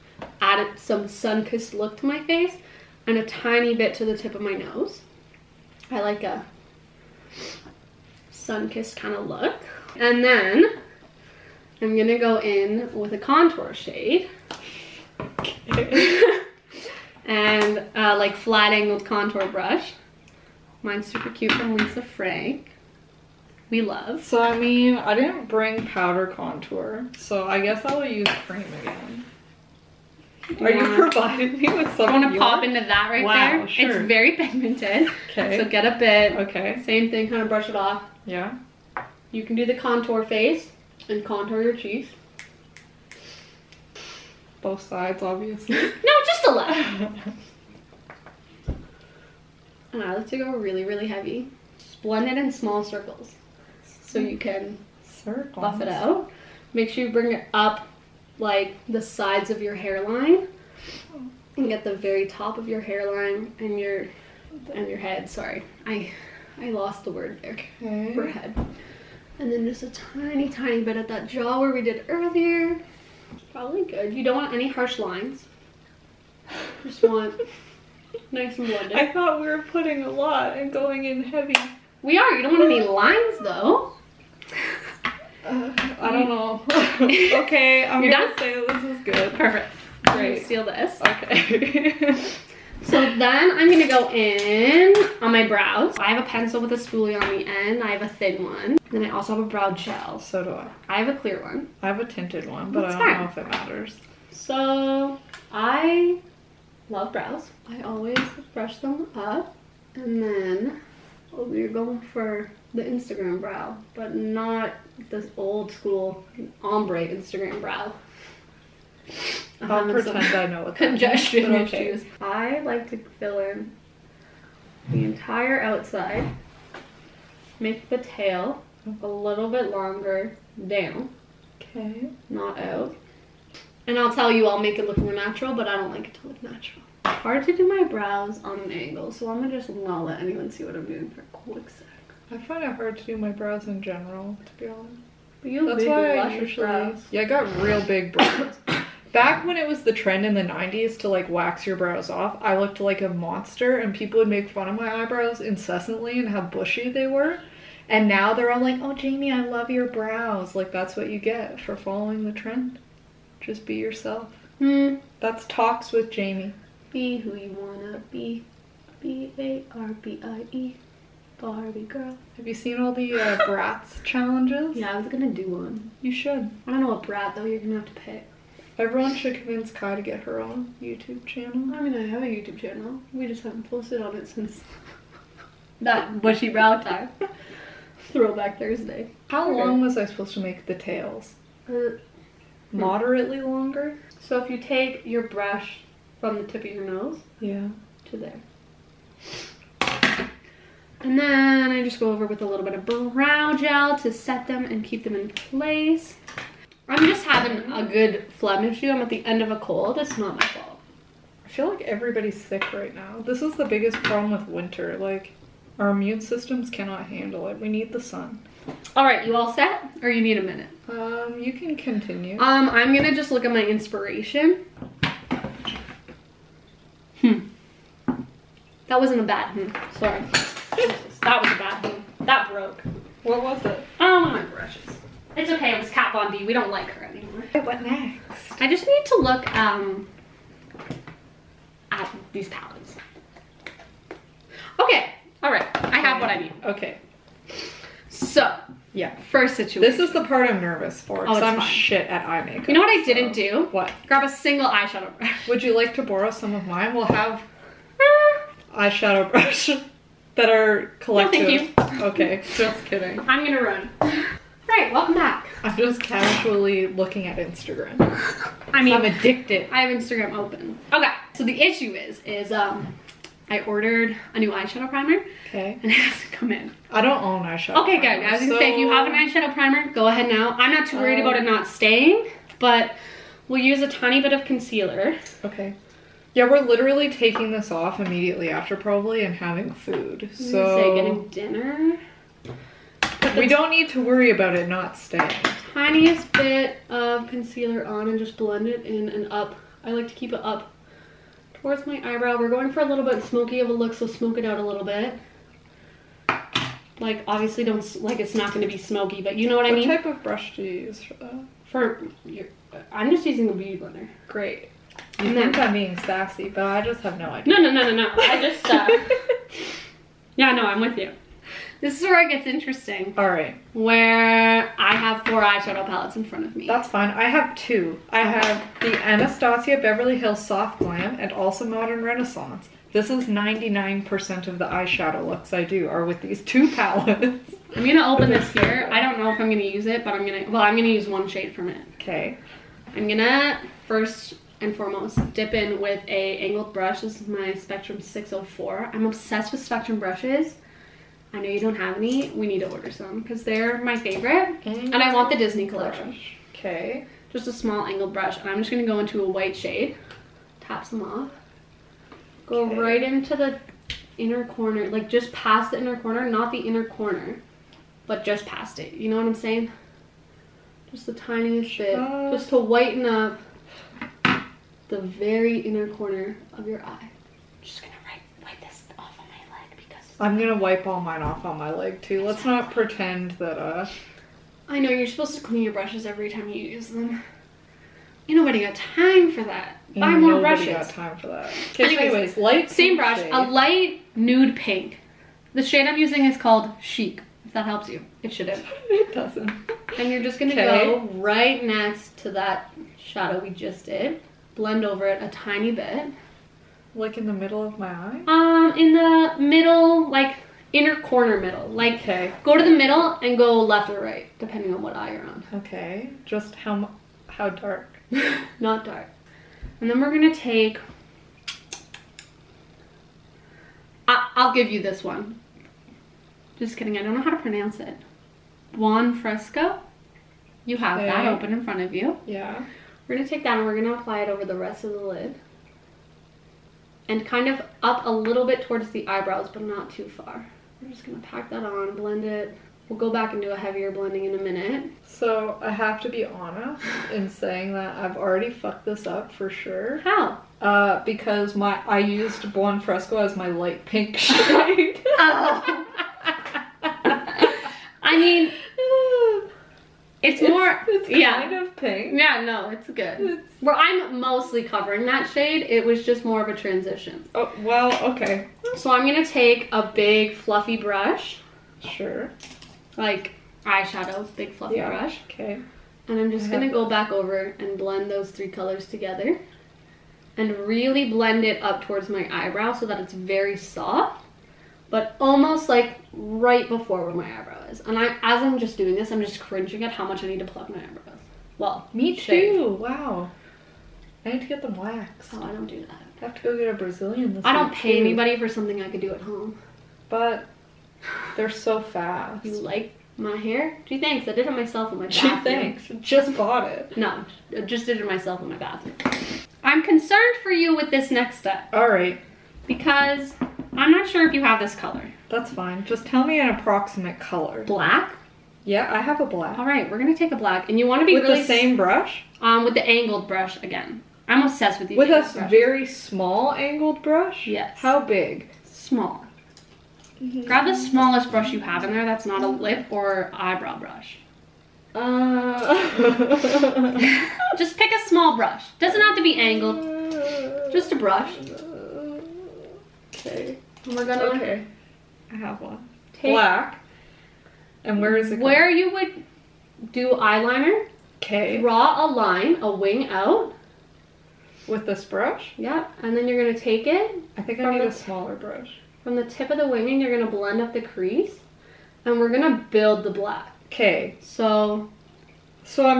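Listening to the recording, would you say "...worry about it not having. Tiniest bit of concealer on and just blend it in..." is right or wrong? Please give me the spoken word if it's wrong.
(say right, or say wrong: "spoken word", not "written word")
wrong: "staying", not "having".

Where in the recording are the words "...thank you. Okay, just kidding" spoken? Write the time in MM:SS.
04:21.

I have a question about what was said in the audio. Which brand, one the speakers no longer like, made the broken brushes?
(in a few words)
Kat Von D.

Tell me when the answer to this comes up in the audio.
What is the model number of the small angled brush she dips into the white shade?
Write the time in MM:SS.
05:47.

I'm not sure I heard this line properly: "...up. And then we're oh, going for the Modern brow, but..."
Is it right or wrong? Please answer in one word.
wrong.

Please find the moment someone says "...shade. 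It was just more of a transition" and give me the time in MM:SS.
07:45.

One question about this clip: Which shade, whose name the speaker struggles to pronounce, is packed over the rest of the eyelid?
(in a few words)
Buon Fresco.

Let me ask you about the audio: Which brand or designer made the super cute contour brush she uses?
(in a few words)
Lisa Frank.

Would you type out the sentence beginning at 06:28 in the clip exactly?
Ain't nobody got time for that.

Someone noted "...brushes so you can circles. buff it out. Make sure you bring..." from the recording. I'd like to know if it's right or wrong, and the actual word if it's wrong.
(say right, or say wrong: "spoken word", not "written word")
wrong: "circles", not "brushes".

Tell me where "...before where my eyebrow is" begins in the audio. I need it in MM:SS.
08:06.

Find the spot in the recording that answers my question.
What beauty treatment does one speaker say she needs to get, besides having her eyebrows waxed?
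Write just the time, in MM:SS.
08:16.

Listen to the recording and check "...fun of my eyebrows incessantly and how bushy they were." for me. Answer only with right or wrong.
right.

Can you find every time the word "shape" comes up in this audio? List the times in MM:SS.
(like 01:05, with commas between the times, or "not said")
not said.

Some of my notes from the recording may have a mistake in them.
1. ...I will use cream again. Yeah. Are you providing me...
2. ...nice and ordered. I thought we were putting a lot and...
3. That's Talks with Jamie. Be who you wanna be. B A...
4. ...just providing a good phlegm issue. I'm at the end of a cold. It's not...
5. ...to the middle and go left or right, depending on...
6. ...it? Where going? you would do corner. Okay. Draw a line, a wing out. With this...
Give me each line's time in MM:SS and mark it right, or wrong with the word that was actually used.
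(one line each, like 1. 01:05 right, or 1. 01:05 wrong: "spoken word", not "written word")
1. 00:27 right
2. 01:18 wrong: "blended", not "ordered"
3. 02:45 right
4. 03:27 wrong: "having", not "providing"
5. 06:52 right
6. 09:08 wrong: "eyeliner", not "corner".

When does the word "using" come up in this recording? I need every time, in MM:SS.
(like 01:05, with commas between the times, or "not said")
05:13, 06:35.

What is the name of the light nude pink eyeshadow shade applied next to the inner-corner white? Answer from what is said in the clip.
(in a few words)
Chic.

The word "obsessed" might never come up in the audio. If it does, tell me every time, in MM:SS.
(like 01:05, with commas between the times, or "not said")
05:49, 08:44.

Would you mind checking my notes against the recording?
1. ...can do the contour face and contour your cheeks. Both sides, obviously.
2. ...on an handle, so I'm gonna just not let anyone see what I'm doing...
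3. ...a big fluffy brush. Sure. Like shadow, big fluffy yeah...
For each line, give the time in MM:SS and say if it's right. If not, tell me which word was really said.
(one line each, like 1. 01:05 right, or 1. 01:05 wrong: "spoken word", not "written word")
1. 00:39 right
2. 02:18 wrong: "angle", not "handle"
3. 07:49 wrong: "eyeshadow", not "shadow".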